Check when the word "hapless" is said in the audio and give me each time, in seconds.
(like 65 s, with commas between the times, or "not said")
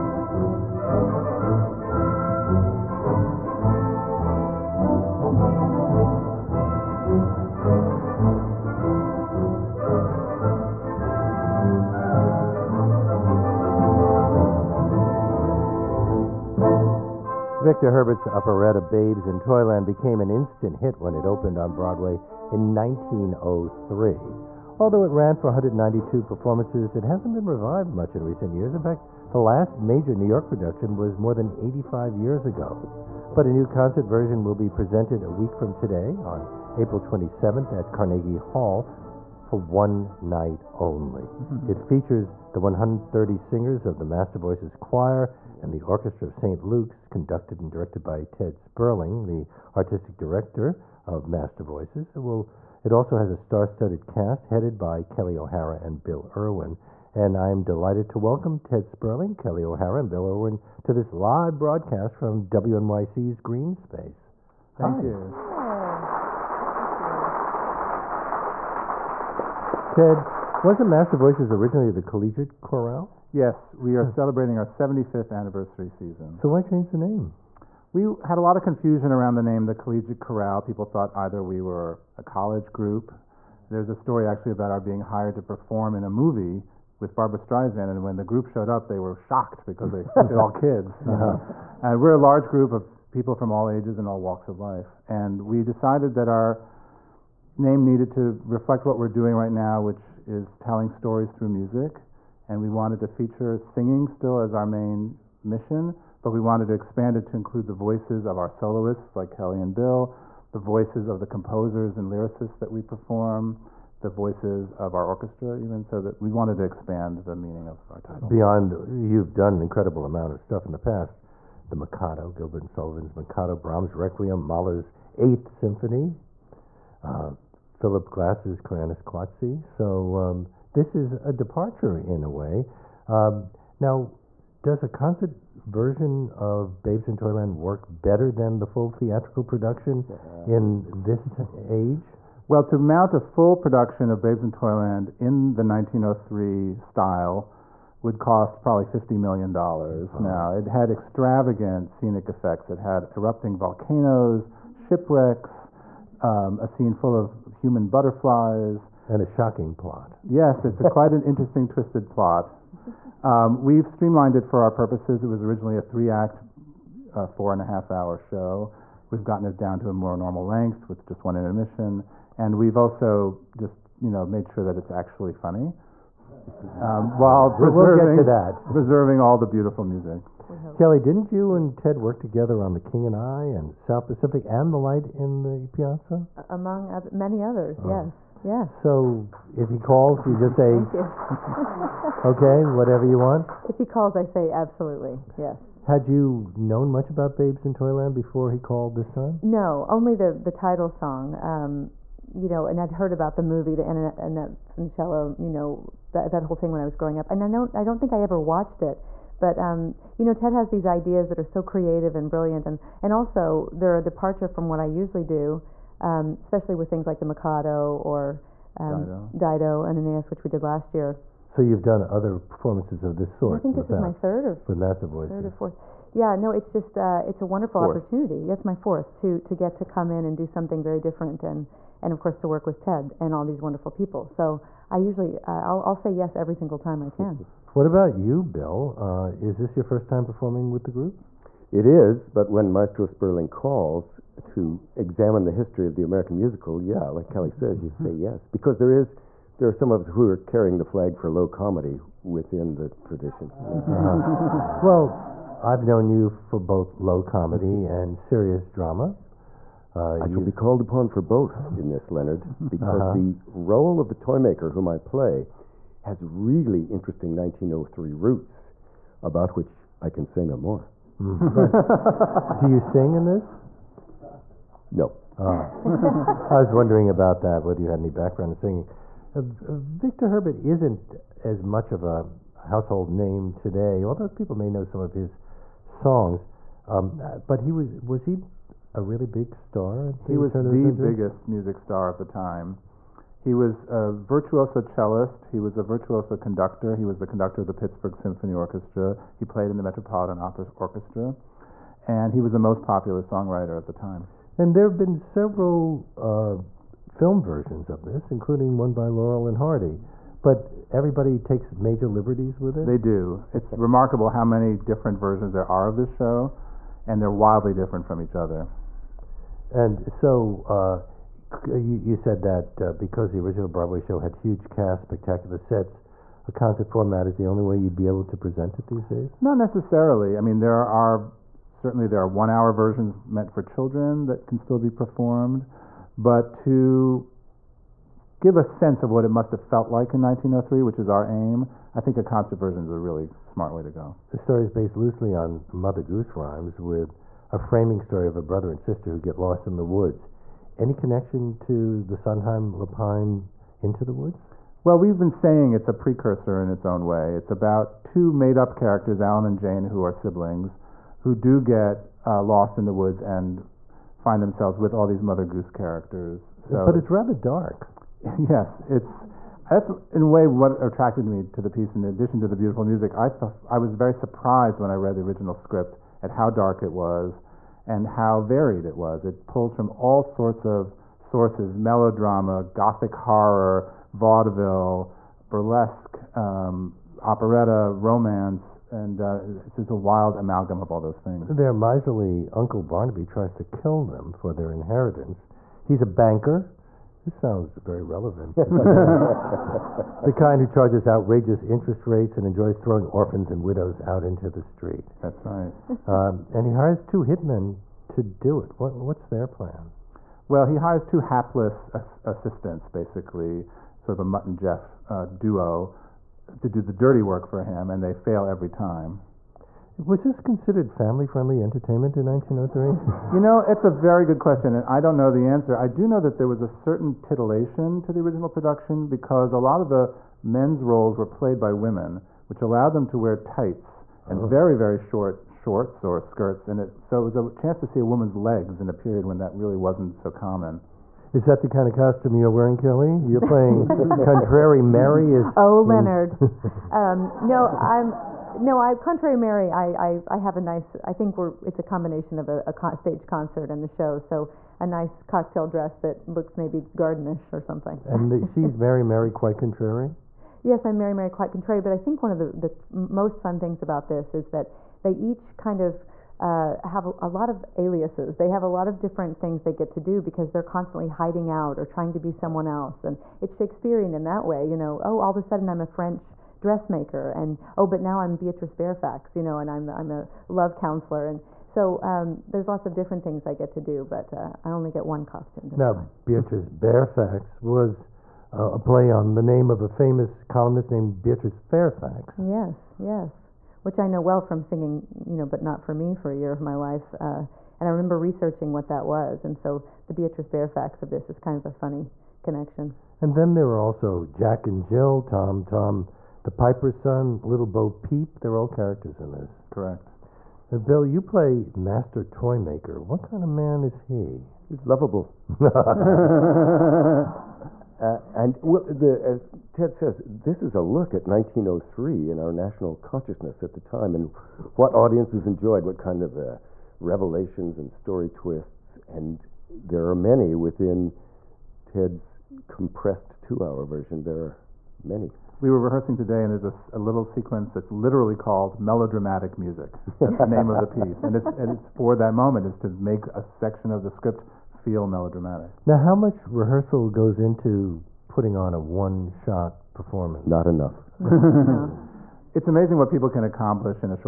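411 s.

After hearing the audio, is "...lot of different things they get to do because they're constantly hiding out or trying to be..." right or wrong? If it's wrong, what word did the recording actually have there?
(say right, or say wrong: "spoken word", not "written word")
right.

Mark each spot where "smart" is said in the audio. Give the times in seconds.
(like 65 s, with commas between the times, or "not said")
343 s.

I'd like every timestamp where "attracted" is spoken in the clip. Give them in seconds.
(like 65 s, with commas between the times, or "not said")
370 s.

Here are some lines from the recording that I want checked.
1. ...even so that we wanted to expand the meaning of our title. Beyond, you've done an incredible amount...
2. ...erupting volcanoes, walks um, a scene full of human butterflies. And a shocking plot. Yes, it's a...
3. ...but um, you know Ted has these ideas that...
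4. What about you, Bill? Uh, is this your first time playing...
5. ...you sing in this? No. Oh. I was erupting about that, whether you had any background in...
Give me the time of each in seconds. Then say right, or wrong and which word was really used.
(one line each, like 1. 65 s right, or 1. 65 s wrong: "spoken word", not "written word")
1. 115 s right
2. 153 s wrong: "shipwrecks", not "walks"
3. 209 s right
4. 237 s wrong: "performing", not "playing"
5. 272 s wrong: "wondering", not "erupting".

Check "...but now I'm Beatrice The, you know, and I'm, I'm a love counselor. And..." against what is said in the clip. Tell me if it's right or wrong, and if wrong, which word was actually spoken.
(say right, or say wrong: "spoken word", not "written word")
wrong: "Fairfax", not "The".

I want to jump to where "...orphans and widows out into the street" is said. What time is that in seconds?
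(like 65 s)
403 s.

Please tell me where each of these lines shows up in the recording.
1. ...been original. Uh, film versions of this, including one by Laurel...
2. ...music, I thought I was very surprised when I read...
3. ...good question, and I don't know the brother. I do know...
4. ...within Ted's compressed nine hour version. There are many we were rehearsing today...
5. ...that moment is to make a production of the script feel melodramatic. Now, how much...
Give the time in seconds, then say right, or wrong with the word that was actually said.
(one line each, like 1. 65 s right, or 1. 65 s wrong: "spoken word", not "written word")
1. 304 s wrong: "several", not "original"
2. 372 s right
3. 424 s wrong: "answer", not "brother"
4. 530 s wrong: "two", not "nine"
5. 542 s wrong: "section", not "production".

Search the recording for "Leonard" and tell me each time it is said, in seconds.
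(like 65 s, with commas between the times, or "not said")
262 s, 445 s.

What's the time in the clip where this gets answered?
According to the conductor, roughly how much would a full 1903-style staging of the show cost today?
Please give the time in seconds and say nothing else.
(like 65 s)
148 s.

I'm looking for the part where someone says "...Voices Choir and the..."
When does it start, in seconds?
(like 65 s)
44 s.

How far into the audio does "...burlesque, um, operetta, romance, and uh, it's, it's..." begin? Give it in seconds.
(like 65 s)
385 s.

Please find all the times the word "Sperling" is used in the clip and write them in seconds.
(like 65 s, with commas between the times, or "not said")
48 s, 58 s, 243 s.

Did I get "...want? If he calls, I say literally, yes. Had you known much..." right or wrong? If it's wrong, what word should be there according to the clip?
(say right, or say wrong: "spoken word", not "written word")
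wrong: "absolutely", not "literally".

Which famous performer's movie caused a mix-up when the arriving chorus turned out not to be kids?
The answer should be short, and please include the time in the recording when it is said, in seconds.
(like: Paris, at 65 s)
Barbra Streisand, at 87 s.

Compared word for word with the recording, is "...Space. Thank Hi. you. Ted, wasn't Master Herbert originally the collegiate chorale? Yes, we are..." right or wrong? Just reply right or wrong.
wrong.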